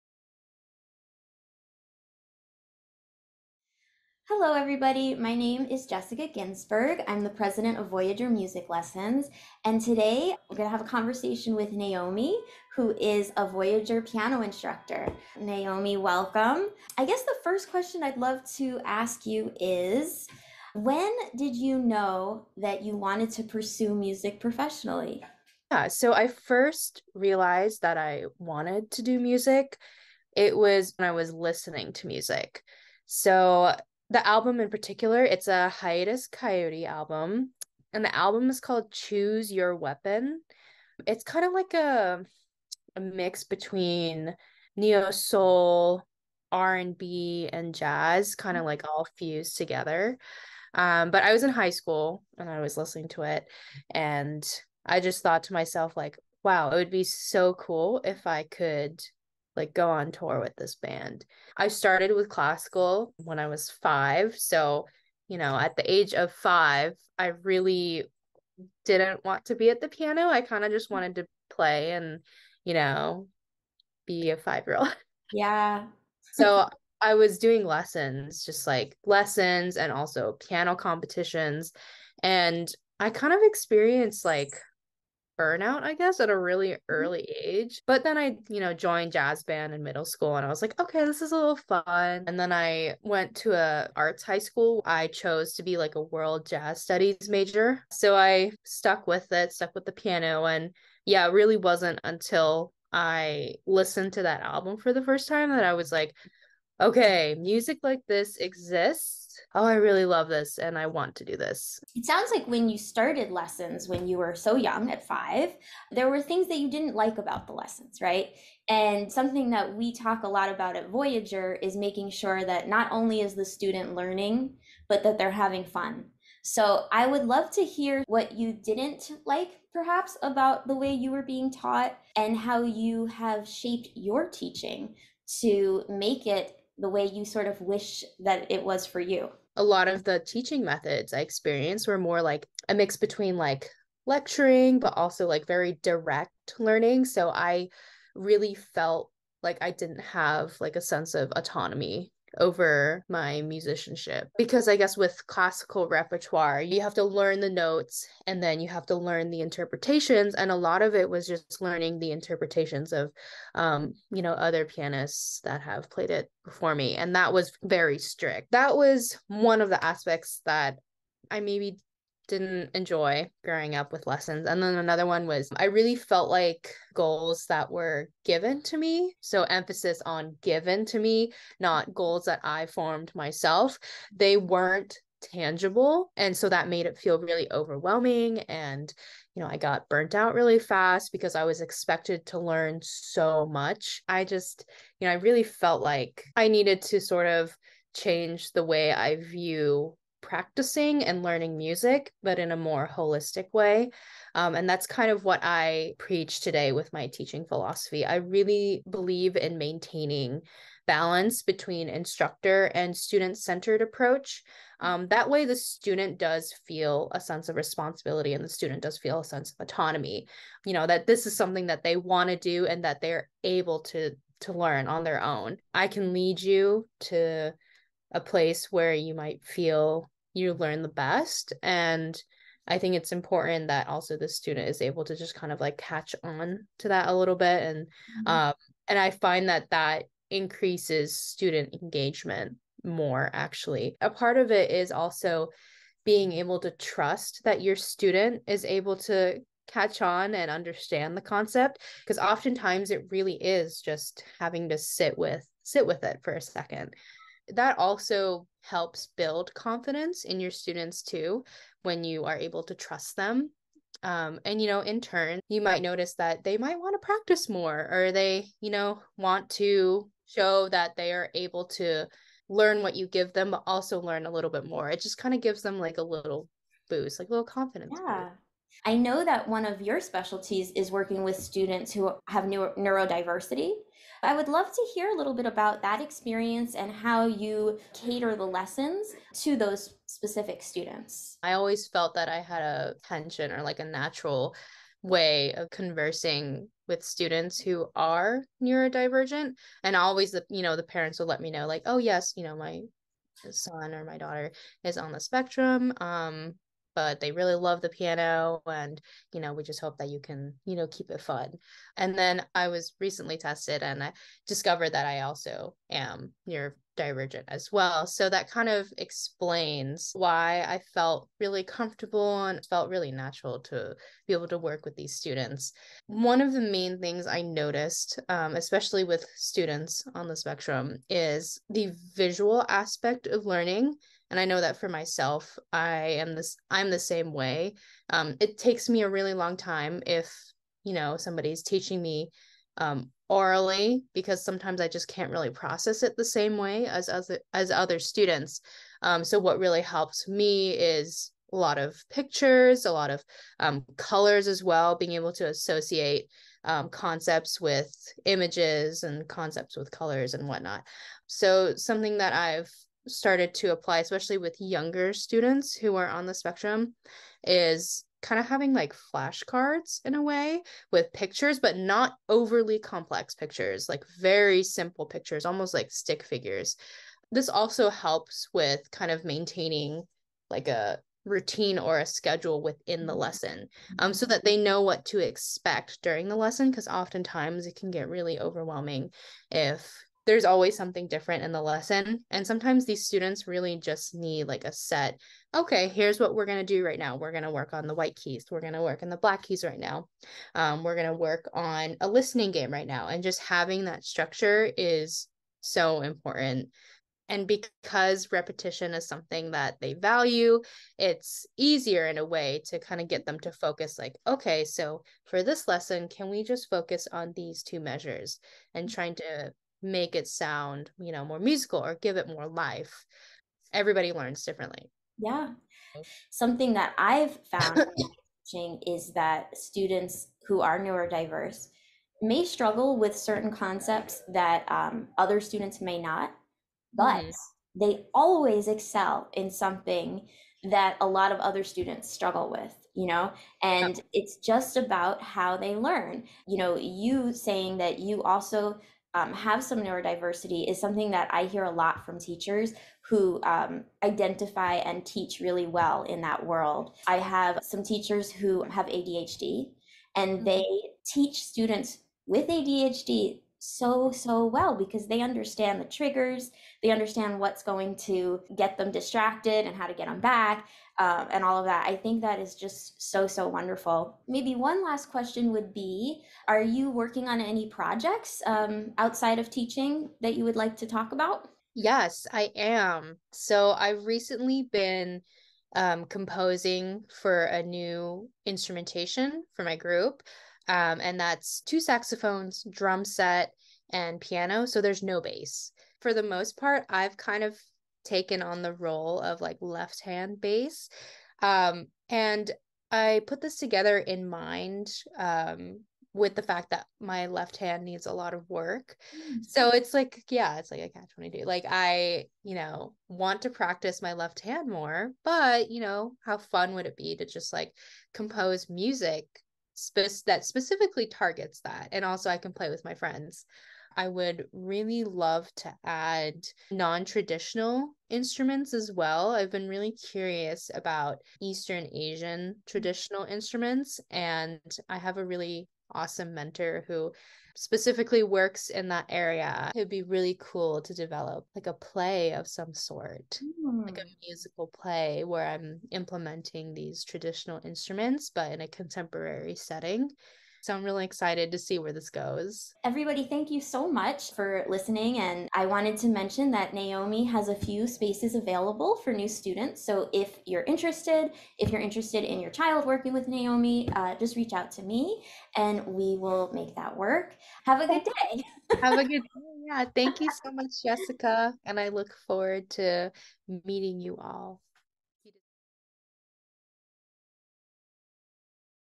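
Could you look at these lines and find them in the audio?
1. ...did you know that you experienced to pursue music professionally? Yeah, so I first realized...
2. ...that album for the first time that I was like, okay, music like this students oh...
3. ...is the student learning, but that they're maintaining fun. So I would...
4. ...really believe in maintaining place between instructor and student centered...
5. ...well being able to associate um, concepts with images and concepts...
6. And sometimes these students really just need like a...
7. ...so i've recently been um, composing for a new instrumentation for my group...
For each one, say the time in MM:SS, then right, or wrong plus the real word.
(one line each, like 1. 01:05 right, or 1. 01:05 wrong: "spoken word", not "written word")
1. 00:21 wrong: "wanted", not "experienced"
2. 01:44 wrong: "exists", not "students"
3. 02:03 wrong: "having", not "maintaining"
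4. 03:28 wrong: "balance", not "place"
5. 05:54 right
6. 06:32 right
7. 08:03 right.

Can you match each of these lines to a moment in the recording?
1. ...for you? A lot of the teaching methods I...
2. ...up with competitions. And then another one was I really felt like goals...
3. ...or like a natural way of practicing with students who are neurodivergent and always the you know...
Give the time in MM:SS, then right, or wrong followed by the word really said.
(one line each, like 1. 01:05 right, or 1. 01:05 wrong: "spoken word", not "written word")
1. 02:18 right
2. 02:53 wrong: "lessons", not "competitions"
3. 04:53 wrong: "conversing", not "practicing".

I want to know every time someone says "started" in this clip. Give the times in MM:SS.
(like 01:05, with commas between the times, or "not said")
01:01, 01:52, 06:03.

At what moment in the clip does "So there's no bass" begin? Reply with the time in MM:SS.
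08:14.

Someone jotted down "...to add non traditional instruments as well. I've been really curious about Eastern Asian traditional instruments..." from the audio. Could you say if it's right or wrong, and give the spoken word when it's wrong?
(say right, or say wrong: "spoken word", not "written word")
right.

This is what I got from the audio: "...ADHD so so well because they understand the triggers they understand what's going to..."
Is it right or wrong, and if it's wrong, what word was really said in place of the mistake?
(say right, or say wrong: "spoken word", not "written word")
right.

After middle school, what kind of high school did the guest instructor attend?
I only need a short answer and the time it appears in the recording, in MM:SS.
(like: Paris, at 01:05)
Arts high school, at 01:33.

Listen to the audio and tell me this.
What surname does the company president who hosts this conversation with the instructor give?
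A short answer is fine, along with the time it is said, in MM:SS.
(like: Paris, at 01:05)
Ginsberg, at 00:05.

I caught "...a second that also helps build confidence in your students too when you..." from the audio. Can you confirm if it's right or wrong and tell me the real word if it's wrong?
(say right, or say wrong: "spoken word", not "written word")
right.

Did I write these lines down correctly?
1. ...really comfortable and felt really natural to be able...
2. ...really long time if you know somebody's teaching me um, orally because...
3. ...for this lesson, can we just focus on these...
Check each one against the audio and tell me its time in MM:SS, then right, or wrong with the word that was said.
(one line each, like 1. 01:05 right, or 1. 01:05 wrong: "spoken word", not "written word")
1. 05:21 right
2. 05:39 right
3. 06:55 right.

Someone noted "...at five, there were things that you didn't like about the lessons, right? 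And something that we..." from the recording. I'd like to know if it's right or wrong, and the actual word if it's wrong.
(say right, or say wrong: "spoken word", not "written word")
right.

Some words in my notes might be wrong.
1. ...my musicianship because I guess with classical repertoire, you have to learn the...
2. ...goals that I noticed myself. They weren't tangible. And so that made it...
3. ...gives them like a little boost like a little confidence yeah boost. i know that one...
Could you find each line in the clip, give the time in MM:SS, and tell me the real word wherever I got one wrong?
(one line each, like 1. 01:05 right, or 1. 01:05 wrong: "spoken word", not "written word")
1. 02:33 right
2. 03:01 wrong: "formed", not "noticed"
3. 04:35 right.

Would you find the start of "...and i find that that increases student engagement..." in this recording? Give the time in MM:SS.
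03:58.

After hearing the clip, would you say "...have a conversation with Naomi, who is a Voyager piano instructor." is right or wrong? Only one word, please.
right.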